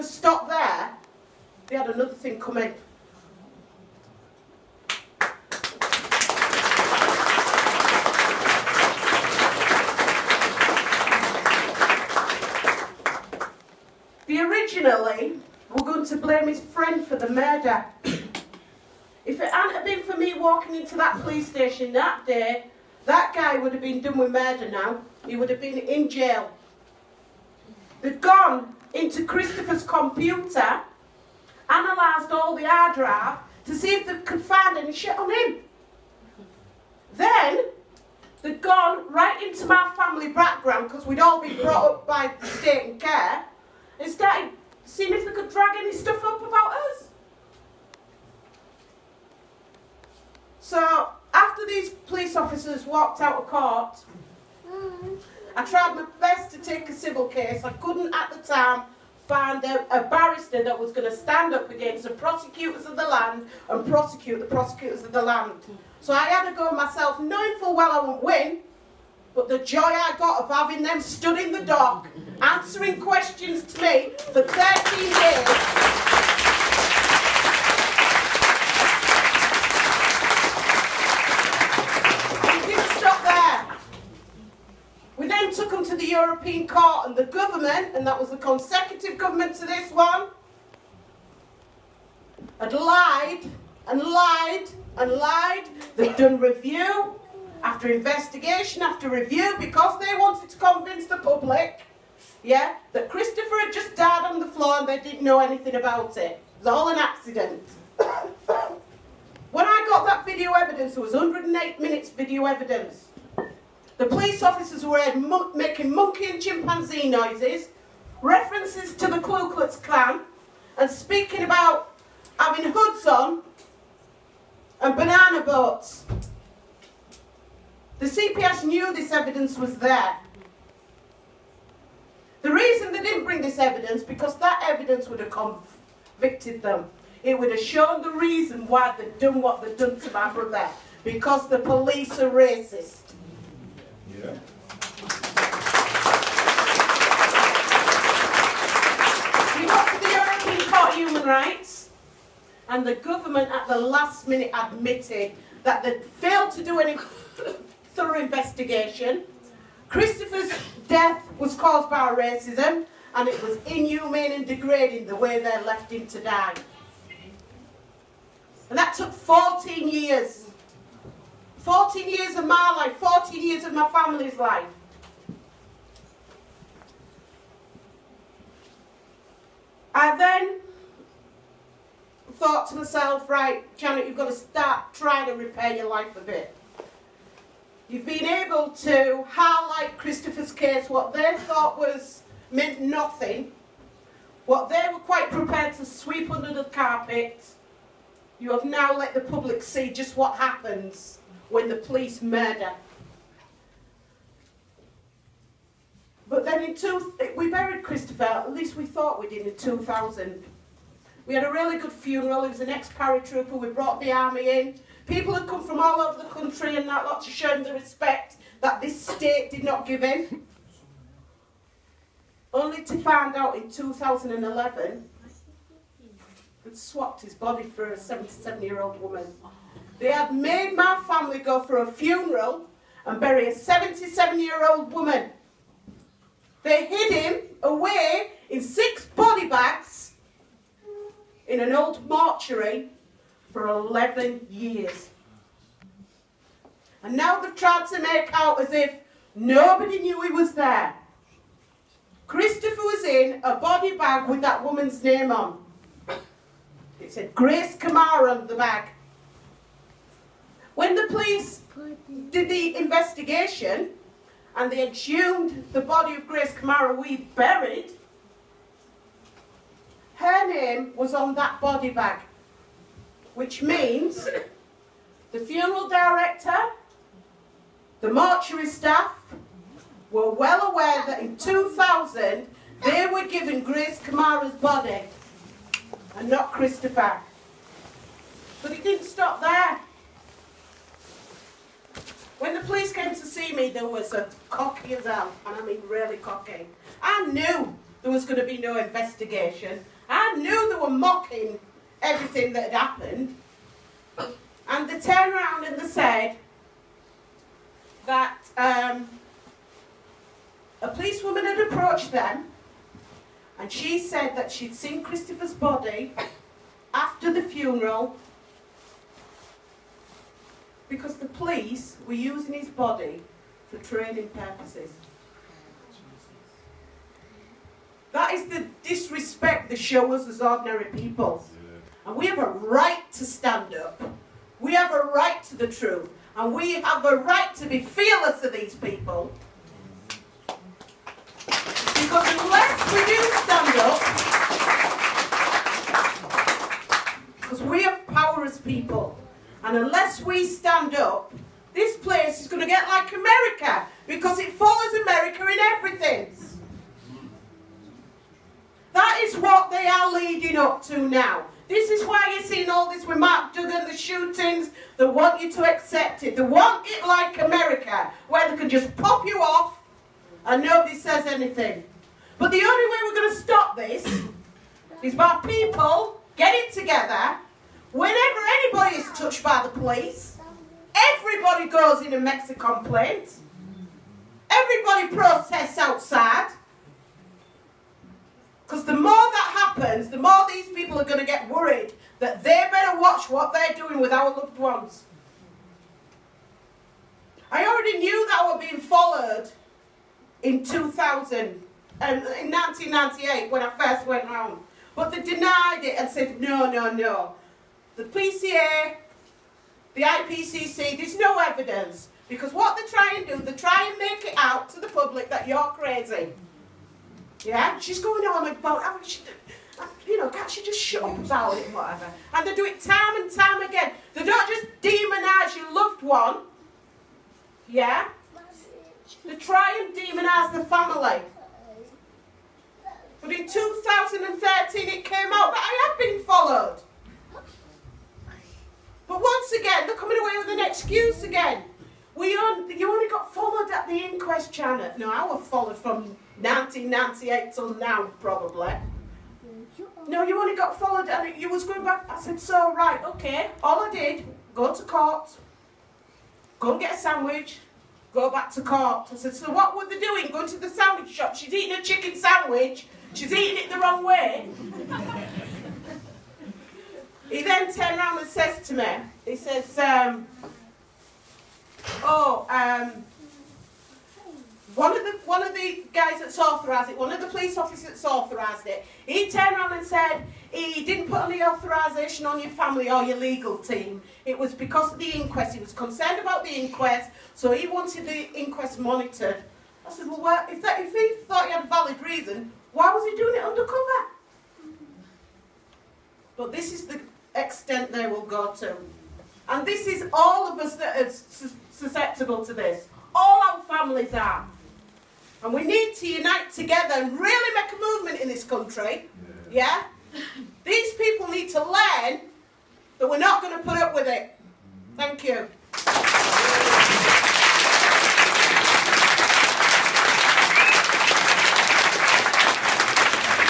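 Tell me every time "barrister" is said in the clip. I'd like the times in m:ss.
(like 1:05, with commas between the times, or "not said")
1:00.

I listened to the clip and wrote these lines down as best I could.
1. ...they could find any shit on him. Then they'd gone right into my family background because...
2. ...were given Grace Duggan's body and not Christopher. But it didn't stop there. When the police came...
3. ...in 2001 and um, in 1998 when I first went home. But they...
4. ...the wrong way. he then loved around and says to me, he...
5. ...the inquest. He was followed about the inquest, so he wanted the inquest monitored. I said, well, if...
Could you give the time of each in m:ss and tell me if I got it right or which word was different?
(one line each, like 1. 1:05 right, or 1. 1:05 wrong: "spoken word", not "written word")
1. 0:34 right
2. 4:43 wrong: "Kamara", not "Duggan"
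3. 6:40 wrong: "2000", not "2001"
4. 7:43 wrong: "turned", not "loved"
5. 8:04 wrong: "concerned", not "followed".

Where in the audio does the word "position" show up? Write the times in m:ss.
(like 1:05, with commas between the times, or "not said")
not said.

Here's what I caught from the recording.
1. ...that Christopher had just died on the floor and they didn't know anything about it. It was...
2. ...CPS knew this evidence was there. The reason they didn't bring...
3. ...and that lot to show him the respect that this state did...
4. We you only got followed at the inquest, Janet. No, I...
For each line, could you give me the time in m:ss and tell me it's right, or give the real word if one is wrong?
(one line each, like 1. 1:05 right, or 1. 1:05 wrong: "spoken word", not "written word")
1. 1:42 right
2. 2:08 right
3. 3:36 right
4. 7:22 right.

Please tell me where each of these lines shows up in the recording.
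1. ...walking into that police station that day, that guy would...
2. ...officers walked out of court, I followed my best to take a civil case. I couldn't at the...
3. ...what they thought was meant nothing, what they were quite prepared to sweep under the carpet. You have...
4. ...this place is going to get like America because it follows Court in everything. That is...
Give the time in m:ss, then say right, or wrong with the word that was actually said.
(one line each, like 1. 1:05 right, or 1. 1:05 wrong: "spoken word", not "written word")
1. 0:20 right
2. 0:52 wrong: "tried", not "followed"
3. 3:10 right
4. 5:51 wrong: "America", not "Court".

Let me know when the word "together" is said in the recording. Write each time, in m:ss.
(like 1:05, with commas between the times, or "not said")
6:16, 8:26.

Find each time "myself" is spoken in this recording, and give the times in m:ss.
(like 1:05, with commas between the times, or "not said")
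1:06, 3:02.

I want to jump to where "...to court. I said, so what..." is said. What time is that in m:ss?
7:38.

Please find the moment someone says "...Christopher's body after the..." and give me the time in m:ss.
5:15.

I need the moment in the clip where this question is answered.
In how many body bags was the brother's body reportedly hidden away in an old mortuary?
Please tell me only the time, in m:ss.
3:58.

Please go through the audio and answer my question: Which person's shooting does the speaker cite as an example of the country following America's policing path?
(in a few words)
Mark Duggan.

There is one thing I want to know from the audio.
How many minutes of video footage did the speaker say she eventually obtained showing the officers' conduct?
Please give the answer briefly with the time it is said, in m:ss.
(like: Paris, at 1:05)
108, at 1:51.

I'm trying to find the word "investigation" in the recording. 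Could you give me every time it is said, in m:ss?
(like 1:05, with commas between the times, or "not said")
1:37, 2:38, 4:22, 4:58.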